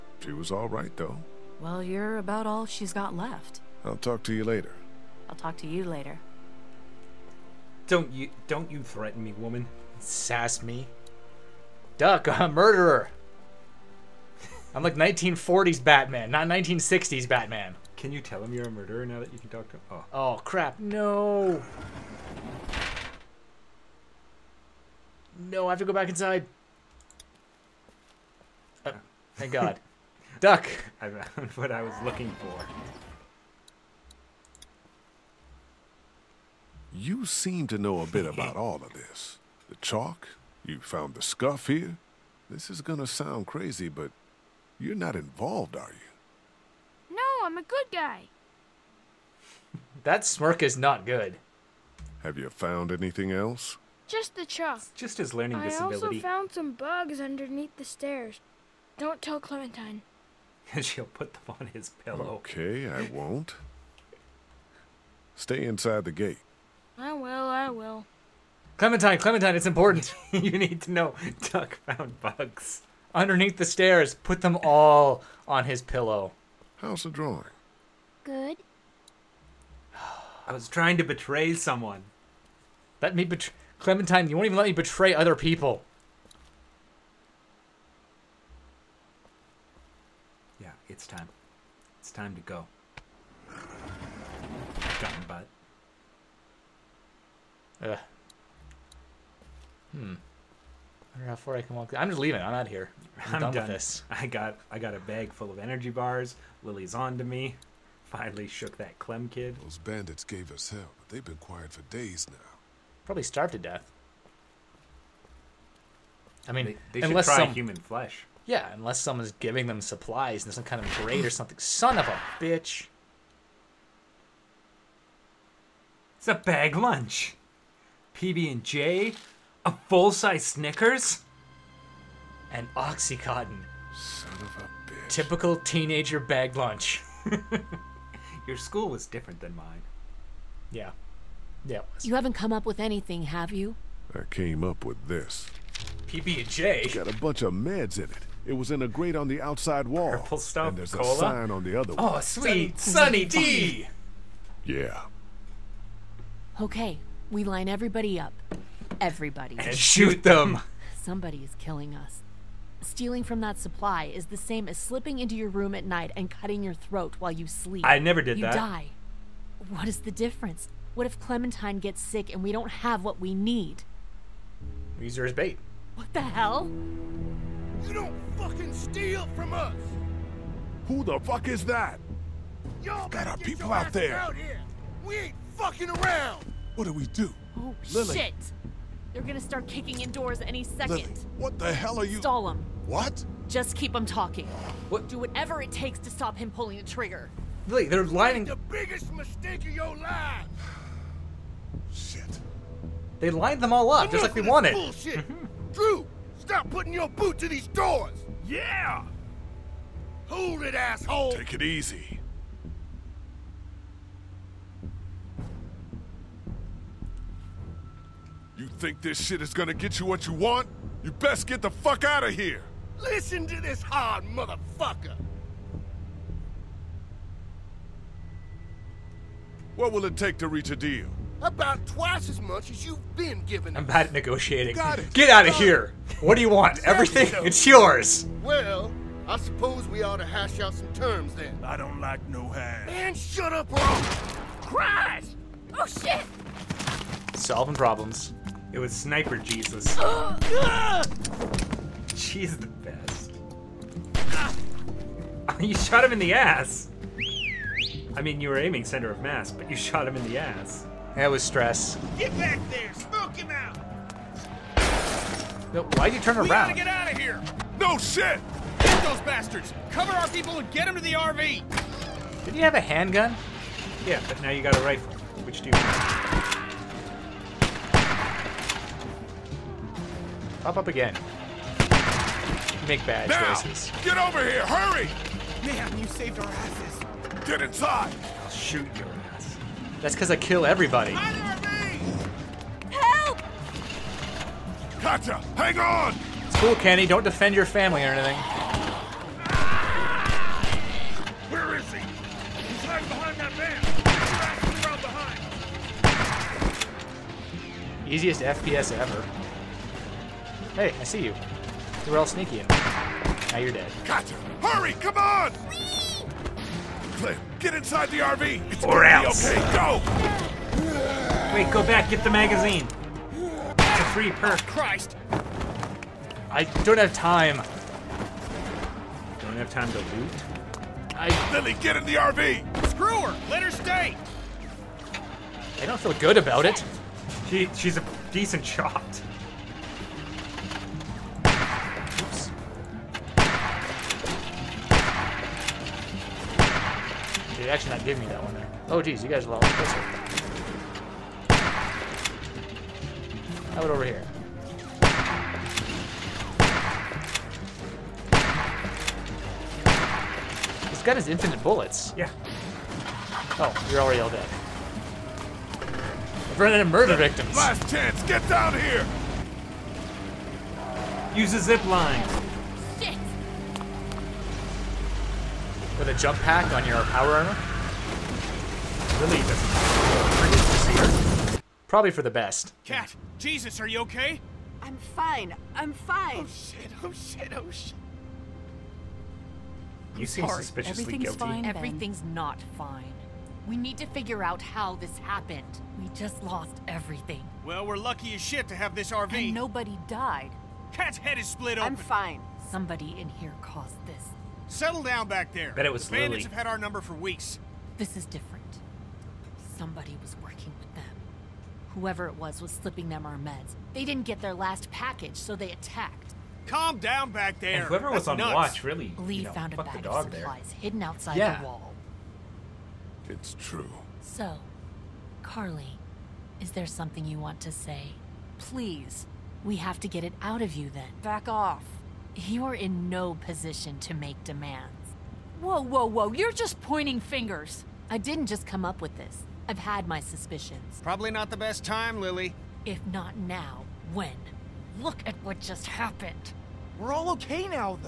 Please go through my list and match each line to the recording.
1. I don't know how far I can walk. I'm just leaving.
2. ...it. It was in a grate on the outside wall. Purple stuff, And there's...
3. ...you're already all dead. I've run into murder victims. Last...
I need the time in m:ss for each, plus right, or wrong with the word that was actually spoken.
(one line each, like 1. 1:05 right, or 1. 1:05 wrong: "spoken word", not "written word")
1. 1:41 right
2. 2:28 right
3. 6:03 right.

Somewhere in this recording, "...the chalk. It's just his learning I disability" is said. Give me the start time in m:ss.
0:54.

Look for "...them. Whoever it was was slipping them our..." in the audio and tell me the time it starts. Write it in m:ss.
6:50.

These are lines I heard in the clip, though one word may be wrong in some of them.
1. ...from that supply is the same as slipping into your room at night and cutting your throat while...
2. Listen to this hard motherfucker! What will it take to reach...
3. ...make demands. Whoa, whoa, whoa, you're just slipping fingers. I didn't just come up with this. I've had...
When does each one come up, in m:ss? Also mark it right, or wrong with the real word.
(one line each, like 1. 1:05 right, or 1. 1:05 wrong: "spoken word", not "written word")
1. 2:43 right
2. 3:42 right
3. 7:14 wrong: "pointing", not "slipping".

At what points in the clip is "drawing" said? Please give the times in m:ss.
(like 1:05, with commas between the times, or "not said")
1:17.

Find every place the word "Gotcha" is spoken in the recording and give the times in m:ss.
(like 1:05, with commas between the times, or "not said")
5:14.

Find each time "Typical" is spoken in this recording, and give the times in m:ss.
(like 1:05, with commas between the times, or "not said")
2:15.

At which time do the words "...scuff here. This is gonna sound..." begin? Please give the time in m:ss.
0:41.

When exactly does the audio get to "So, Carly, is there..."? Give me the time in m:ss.
7:04.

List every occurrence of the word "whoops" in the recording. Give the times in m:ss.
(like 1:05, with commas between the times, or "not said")
not said.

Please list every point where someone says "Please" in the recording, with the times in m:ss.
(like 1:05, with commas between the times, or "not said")
7:08.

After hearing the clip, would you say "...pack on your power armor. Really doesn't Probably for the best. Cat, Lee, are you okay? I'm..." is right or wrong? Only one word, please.
wrong.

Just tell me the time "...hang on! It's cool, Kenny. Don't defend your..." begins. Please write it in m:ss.
4:55.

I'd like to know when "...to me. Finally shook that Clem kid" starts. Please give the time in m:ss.
1:47.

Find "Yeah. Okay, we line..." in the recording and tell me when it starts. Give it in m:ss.
2:34.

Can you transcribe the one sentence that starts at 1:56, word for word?
I mean, they, they unless should try some, human flesh.